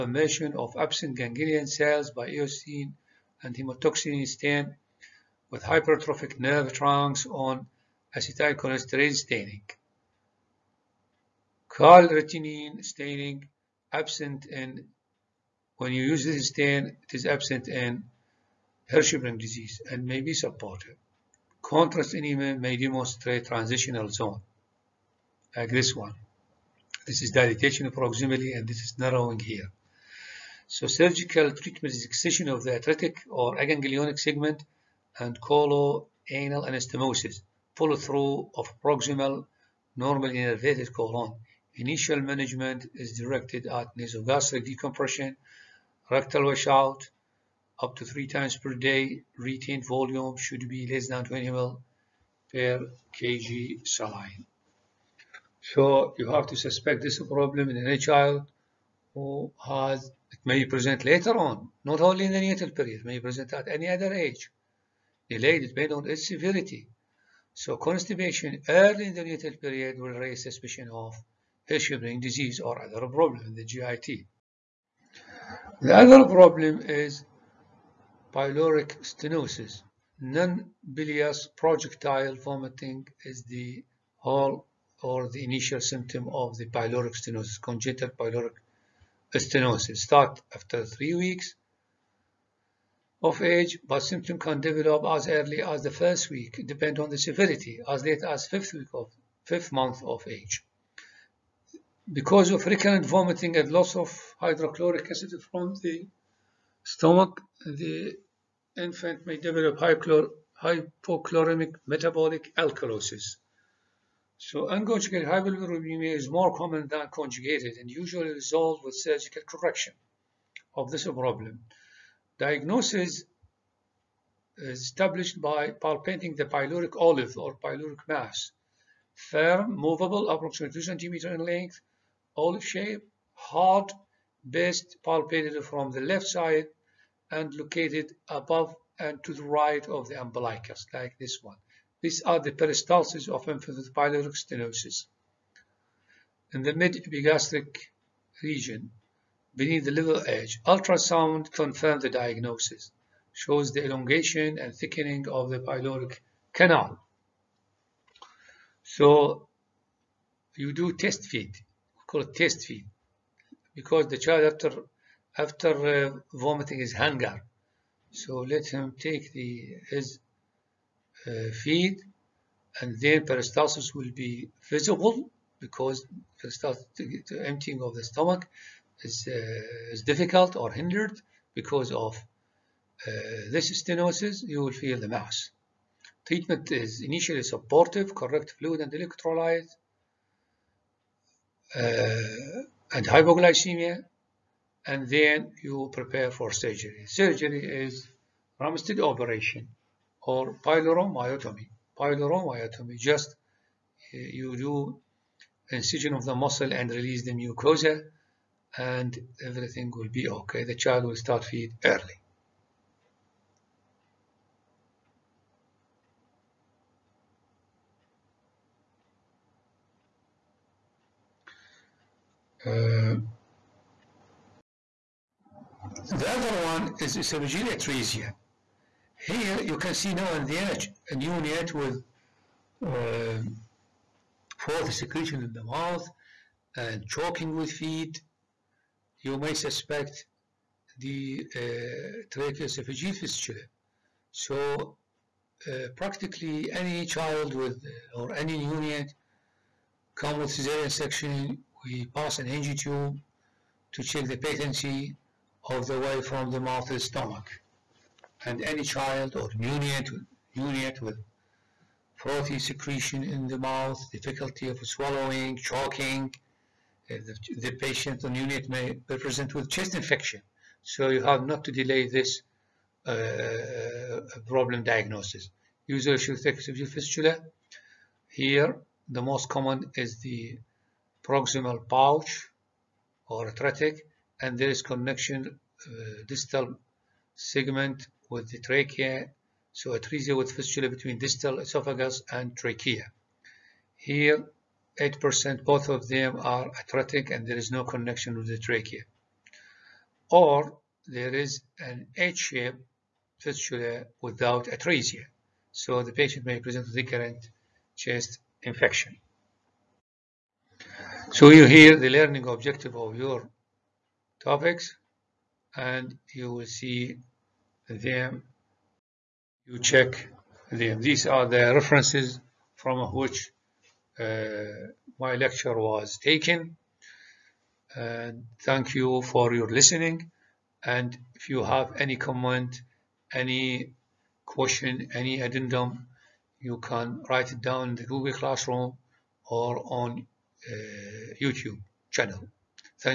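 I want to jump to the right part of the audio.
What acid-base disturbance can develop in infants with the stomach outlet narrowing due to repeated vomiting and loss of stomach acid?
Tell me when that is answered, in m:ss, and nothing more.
1:49.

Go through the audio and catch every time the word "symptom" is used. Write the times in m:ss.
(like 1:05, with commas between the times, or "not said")
1:25, 1:34.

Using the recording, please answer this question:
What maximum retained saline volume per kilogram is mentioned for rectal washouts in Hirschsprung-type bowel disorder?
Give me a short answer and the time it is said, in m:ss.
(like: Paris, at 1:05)
20 ml per kg, at 0:51.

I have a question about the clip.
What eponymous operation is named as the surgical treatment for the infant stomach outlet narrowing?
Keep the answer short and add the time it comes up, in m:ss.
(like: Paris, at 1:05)
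Ramstedt operation, at 3:18.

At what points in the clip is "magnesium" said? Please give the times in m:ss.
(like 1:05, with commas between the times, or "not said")
not said.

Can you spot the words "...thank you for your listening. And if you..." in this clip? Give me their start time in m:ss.
5:28.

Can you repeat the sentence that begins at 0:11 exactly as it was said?
Calretinin staining absent in when you use this stain, it is absent in Hirschsprung disease and may be supportive.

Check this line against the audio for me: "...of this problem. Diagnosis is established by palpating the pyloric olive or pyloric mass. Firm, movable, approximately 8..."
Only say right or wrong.
wrong.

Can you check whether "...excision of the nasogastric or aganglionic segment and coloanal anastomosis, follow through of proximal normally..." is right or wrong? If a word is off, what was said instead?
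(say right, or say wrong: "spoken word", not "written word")
wrong: "atretic", not "nasogastric".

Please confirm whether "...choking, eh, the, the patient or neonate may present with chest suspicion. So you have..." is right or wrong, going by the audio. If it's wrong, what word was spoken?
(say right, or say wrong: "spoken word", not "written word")
wrong: "infection", not "suspicion".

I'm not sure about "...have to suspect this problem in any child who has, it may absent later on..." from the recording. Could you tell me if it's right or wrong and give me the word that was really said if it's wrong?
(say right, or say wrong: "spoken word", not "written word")
wrong: "present", not "absent".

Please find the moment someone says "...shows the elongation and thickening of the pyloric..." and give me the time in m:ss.
2:33.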